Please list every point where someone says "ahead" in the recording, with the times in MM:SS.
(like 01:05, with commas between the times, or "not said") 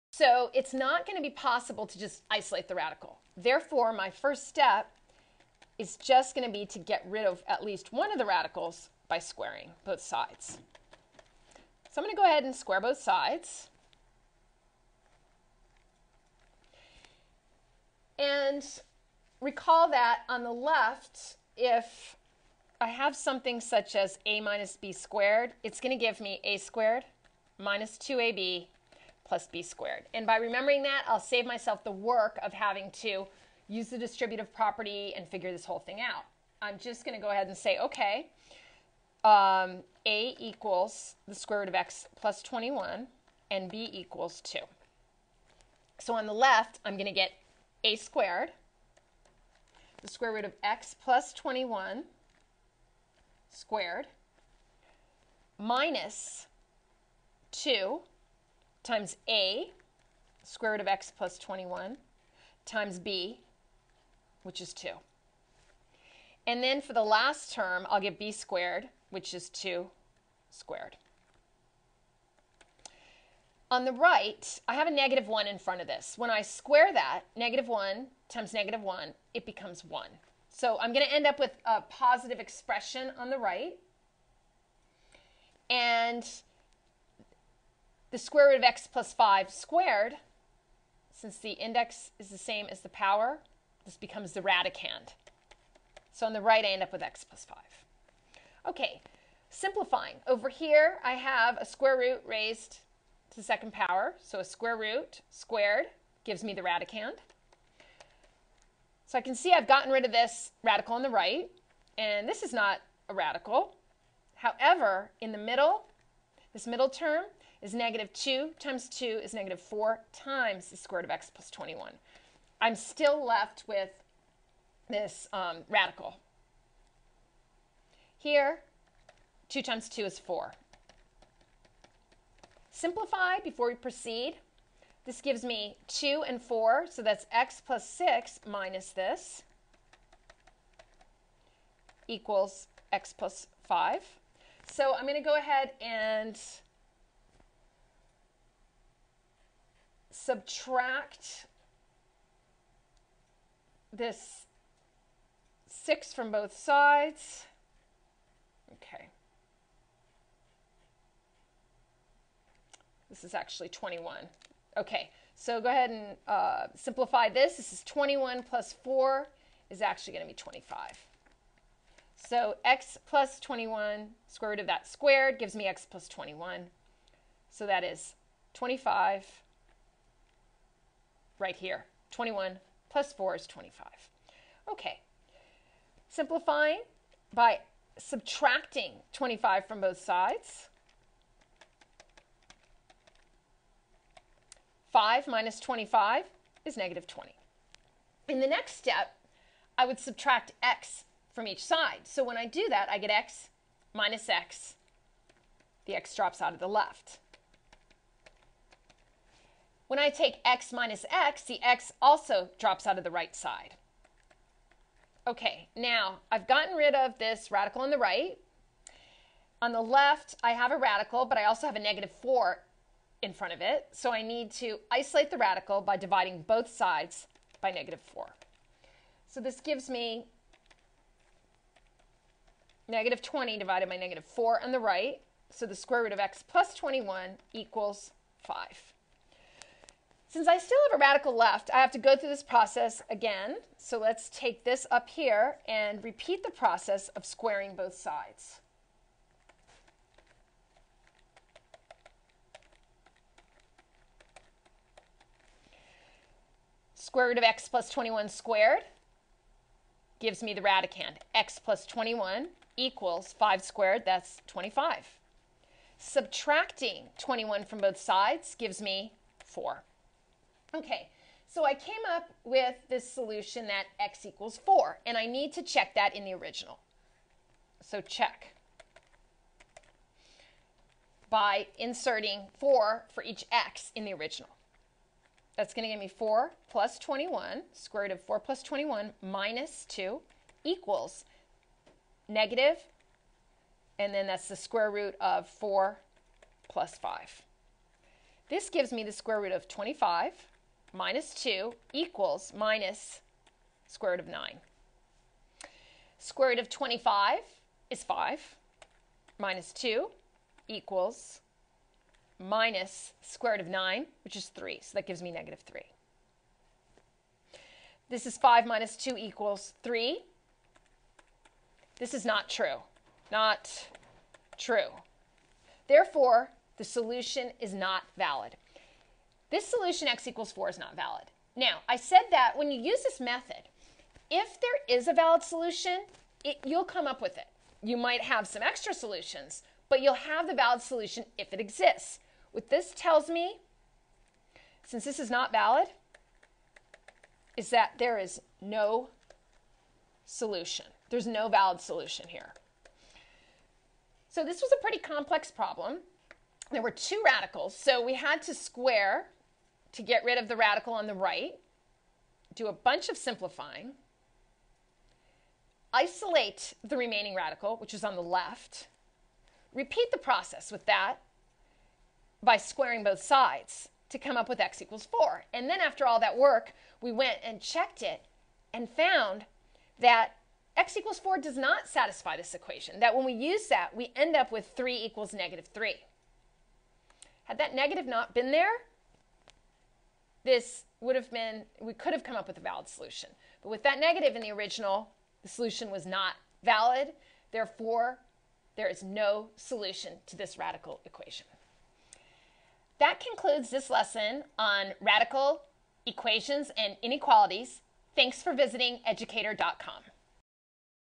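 00:12, 00:37, 02:25, 02:45.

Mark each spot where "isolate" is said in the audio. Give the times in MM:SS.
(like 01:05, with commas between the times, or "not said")
00:02, 03:44, 06:05.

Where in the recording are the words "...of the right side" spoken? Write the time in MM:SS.
03:32.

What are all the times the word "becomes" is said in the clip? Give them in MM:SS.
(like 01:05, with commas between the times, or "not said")
01:19, 01:33.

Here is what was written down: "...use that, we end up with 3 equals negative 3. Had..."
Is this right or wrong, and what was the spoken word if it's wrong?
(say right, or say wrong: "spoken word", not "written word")
right.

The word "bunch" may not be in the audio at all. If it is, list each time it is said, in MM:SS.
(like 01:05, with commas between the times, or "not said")
06:02.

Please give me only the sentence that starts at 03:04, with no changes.
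Okay, simplifying by subtracting 25 from both sides.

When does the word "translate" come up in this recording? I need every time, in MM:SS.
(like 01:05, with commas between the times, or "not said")
not said.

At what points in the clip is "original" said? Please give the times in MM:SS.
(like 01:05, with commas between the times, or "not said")
04:36, 04:44, 06:34.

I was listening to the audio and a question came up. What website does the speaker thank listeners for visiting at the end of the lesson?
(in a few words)
educator.com.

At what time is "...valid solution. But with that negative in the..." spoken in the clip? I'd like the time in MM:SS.
06:32.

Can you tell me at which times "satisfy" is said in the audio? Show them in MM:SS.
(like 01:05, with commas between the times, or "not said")
06:21.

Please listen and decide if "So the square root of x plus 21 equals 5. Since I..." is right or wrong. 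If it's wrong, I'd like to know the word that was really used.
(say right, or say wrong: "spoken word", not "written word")
right.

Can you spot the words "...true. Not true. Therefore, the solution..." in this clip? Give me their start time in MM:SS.
05:22.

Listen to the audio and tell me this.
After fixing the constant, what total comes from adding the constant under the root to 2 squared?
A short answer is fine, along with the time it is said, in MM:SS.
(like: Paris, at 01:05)
25, at 02:47.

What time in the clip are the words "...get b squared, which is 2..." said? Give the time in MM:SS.
01:08.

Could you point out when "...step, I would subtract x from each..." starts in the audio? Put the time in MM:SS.
03:18.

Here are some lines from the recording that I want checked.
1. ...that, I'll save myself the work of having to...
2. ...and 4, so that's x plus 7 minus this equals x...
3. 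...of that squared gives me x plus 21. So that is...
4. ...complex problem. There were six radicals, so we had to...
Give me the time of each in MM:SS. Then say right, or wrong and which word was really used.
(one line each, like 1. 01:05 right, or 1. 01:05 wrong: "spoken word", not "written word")
1. 00:30 right
2. 02:16 wrong: "6", not "7"
3. 02:54 right
4. 05:54 wrong: "two", not "six".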